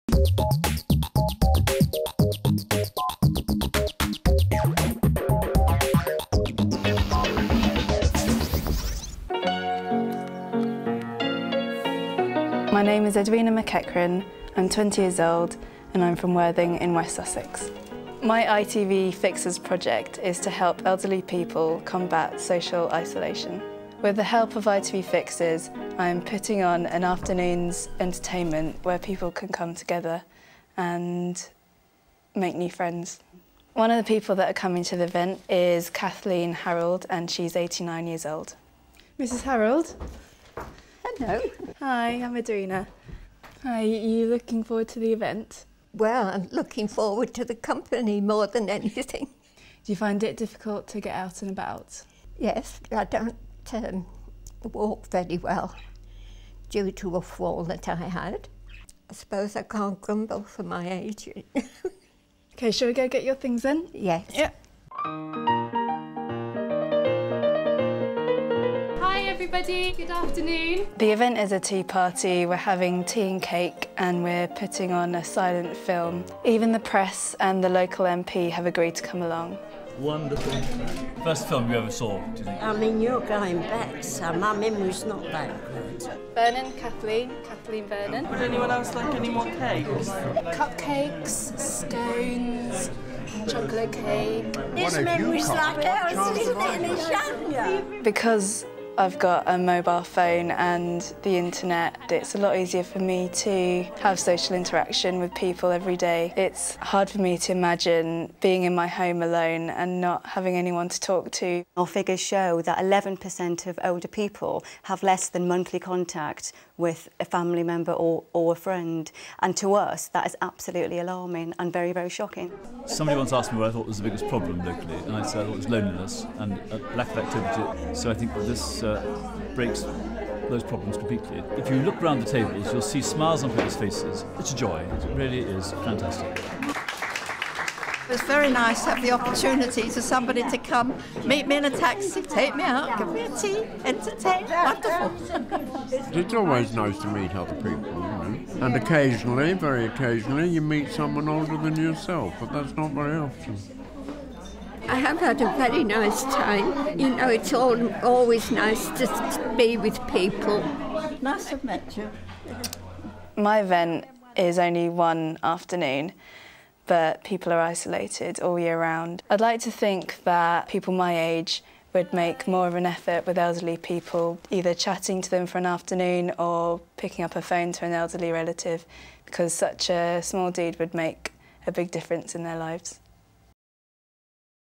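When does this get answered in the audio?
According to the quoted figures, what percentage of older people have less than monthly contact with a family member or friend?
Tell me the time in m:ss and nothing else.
1:52.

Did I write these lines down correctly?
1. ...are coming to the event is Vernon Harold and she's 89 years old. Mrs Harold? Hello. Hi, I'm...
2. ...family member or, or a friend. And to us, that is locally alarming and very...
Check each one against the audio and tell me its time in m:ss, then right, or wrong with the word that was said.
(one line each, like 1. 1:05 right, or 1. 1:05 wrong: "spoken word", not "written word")
1. 0:34 wrong: "Kathleen", not "Vernon"
2. 1:57 wrong: "absolutely", not "locally".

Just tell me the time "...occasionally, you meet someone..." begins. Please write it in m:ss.
2:29.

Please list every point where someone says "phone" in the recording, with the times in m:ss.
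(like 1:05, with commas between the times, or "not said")
1:40, 2:57.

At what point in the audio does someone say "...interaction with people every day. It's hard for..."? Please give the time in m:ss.
1:44.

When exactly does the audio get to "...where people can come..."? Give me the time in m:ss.
0:28.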